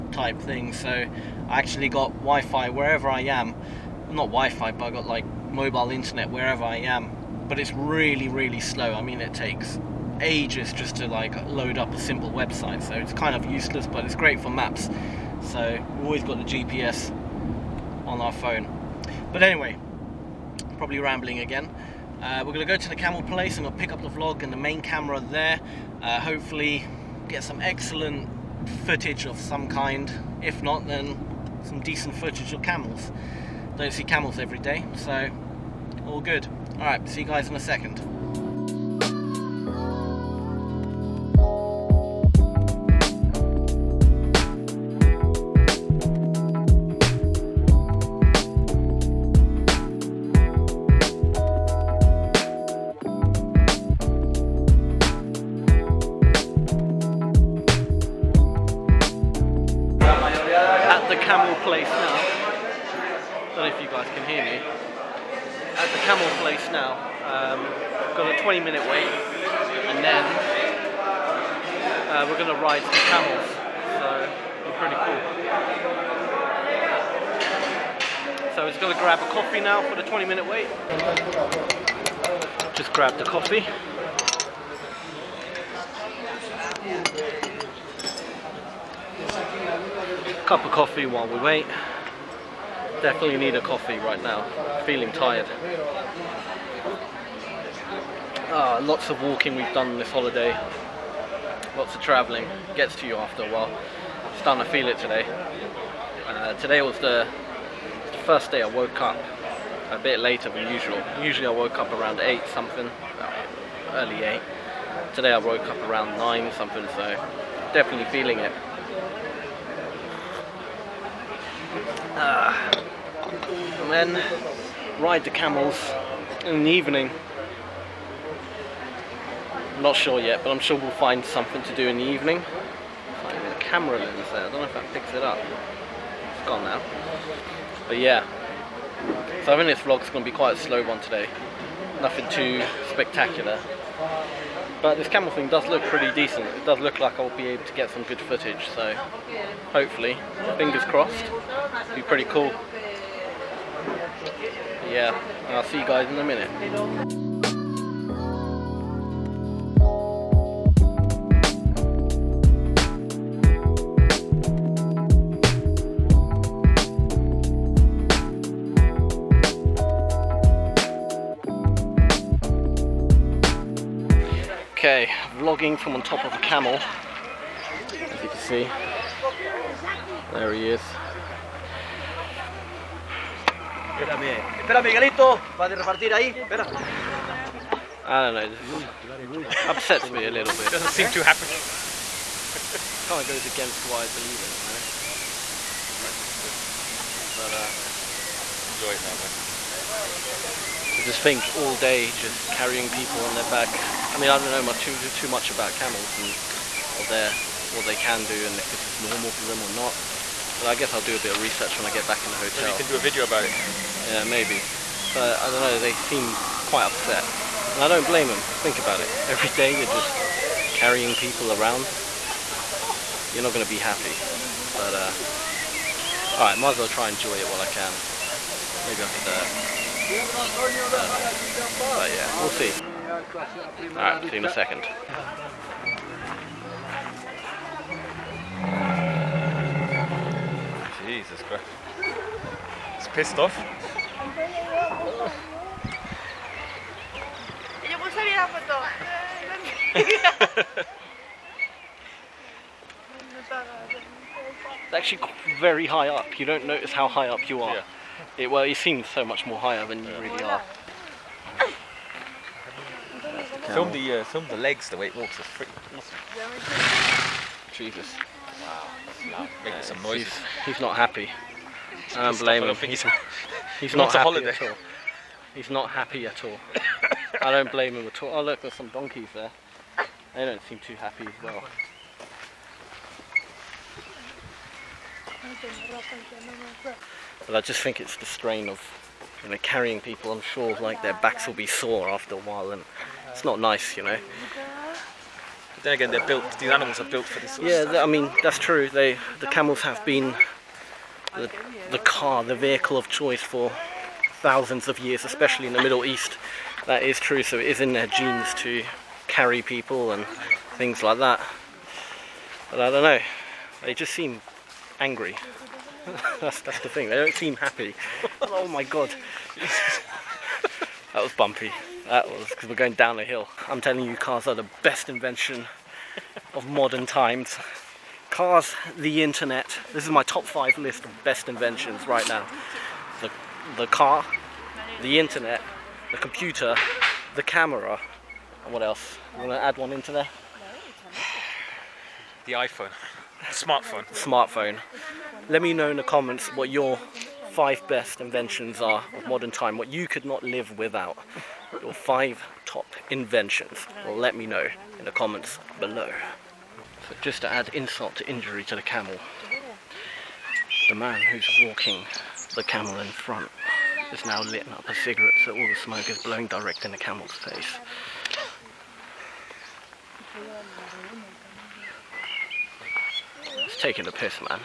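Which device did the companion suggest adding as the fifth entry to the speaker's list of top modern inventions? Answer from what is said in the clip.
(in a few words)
iPhone.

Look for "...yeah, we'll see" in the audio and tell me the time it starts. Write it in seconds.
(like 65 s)
232 s.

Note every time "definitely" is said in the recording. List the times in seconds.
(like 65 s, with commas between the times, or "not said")
93 s, 117 s.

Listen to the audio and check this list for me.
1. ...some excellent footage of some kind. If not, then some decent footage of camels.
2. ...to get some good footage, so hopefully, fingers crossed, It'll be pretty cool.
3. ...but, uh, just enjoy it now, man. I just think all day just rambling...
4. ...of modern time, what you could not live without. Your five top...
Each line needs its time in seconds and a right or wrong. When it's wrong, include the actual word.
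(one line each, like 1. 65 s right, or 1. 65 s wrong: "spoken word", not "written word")
1. 27 s right
2. 147 s right
3. 197 s wrong: "carrying", not "rambling"
4. 349 s right.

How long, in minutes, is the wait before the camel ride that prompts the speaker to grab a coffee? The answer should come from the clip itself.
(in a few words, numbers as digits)
20 minutes.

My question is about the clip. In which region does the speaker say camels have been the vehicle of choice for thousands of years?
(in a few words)
Middle East.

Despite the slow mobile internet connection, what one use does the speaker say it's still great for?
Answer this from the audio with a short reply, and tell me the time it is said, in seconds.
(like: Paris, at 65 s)
Maps, at 14 s.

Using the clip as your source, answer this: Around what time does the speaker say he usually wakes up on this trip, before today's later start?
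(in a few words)
8.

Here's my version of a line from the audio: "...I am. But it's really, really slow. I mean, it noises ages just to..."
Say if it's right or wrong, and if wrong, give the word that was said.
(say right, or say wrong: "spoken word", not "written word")
wrong: "takes", not "noises".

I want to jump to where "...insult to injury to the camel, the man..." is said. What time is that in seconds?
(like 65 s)
357 s.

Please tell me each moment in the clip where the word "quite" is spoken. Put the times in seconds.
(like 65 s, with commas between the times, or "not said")
140 s, 216 s.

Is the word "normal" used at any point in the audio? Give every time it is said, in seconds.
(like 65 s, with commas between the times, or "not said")
208 s.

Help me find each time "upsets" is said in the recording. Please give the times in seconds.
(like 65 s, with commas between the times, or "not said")
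189 s, 216 s.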